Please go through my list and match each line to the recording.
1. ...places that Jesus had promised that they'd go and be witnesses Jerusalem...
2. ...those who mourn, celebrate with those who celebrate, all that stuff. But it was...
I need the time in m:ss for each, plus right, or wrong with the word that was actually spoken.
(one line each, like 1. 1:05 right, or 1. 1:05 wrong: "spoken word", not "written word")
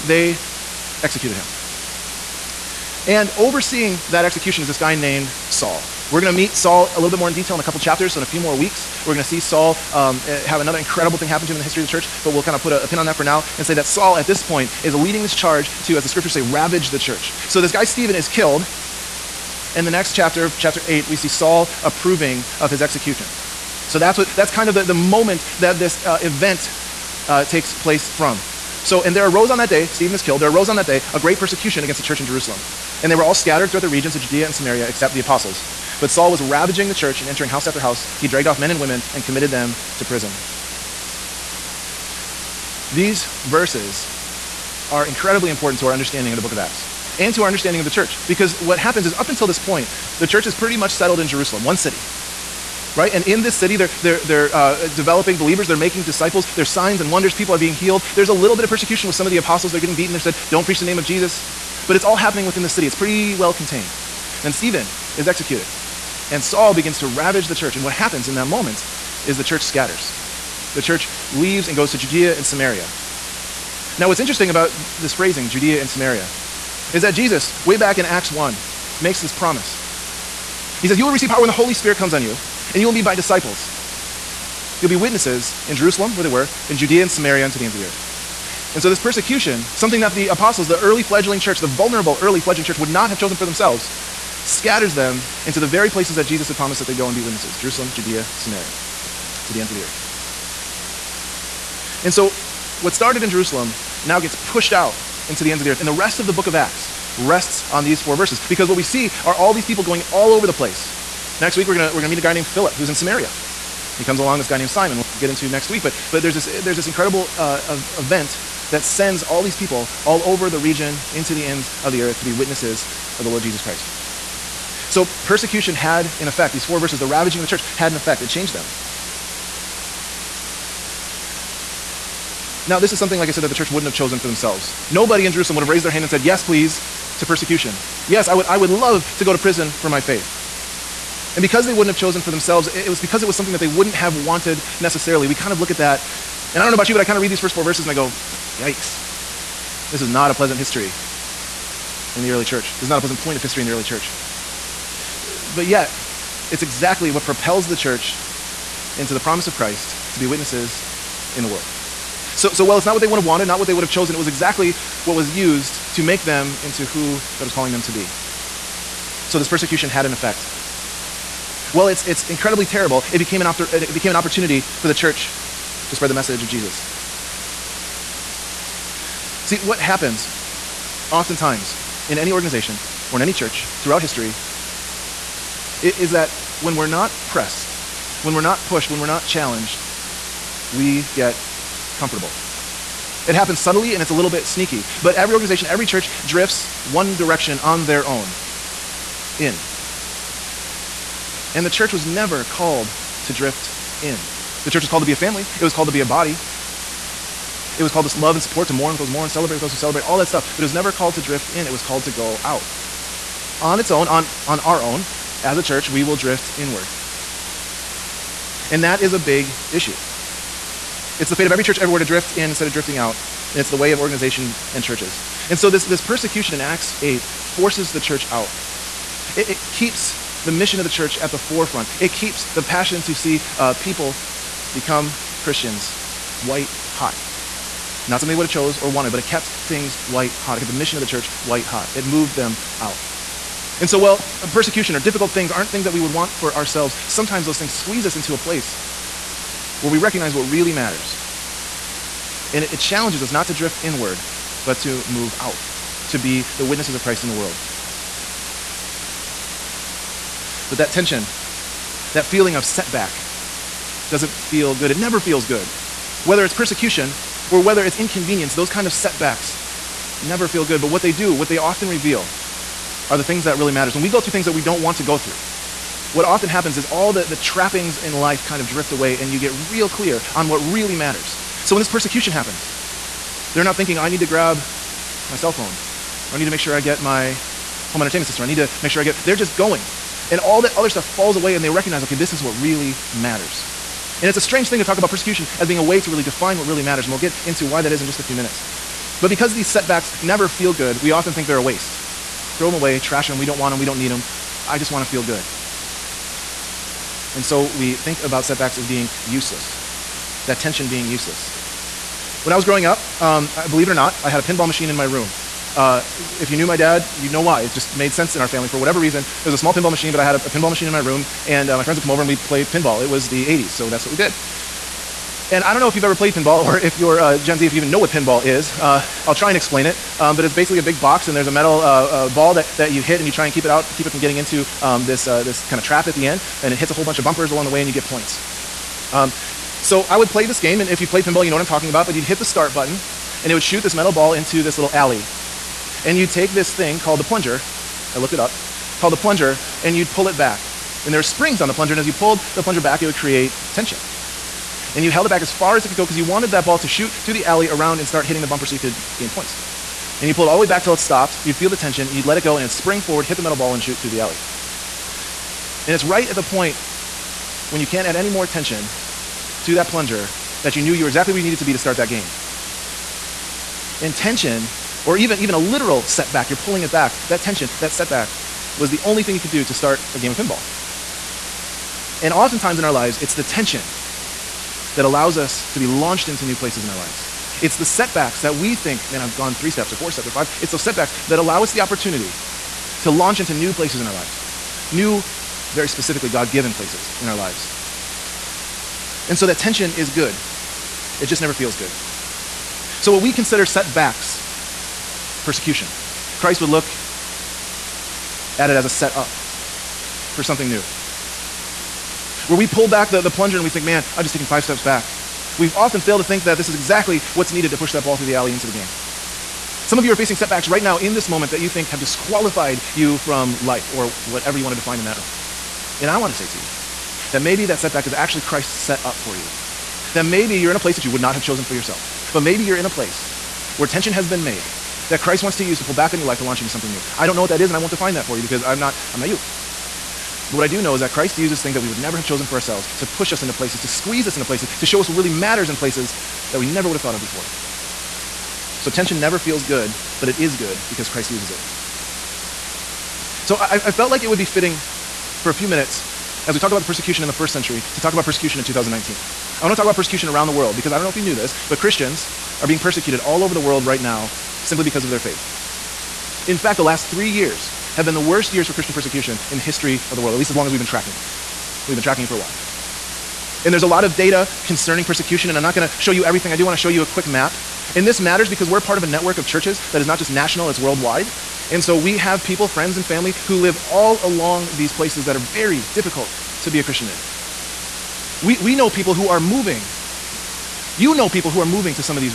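1. 1:35 right
2. 3:28 right.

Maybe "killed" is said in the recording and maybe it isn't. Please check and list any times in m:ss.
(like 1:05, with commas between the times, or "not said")
0:18, 0:30.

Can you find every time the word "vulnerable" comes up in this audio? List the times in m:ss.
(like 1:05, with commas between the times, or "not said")
1:31.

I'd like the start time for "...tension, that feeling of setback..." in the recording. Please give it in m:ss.
4:20.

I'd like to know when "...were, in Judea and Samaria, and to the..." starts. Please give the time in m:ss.
1:26.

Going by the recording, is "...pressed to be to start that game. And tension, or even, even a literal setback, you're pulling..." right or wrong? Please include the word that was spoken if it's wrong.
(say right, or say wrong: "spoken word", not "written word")
wrong: "needed", not "pressed".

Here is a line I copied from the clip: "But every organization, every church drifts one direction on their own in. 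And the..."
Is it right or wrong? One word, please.
right.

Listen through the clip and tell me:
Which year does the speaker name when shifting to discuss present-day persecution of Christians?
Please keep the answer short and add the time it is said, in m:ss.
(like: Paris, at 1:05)
2019, at 7:38.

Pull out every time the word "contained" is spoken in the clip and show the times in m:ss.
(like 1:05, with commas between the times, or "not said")
1:03.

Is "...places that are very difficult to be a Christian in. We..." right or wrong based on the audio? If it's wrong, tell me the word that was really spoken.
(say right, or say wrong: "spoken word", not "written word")
right.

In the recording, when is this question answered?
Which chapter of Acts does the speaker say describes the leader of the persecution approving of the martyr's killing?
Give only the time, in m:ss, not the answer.
0:20.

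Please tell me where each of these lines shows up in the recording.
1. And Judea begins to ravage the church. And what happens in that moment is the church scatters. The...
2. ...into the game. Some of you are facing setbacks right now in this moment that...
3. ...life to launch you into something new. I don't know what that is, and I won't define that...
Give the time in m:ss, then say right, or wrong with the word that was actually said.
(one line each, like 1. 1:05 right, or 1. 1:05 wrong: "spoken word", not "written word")
1. 1:06 wrong: "Saul", not "Judea"
2. 6:58 right
3. 7:16 right.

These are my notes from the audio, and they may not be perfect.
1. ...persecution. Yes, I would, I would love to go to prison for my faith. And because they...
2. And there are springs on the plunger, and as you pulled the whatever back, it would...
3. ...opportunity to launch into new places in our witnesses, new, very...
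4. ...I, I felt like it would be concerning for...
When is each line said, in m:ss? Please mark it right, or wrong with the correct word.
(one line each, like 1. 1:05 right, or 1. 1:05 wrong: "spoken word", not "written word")
1. 2:17 right
2. 5:51 wrong: "plunger", not "whatever"
3. 6:31 wrong: "lives", not "witnesses"
4. 7:33 wrong: "fitting", not "concerning".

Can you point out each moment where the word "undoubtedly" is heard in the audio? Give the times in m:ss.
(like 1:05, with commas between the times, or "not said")
not said.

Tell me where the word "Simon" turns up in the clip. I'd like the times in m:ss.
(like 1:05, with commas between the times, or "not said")
1:54.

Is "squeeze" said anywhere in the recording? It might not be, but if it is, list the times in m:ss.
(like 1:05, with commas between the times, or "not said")
4:07, 7:23.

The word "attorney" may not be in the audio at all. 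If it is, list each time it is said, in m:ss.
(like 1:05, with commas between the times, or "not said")
not said.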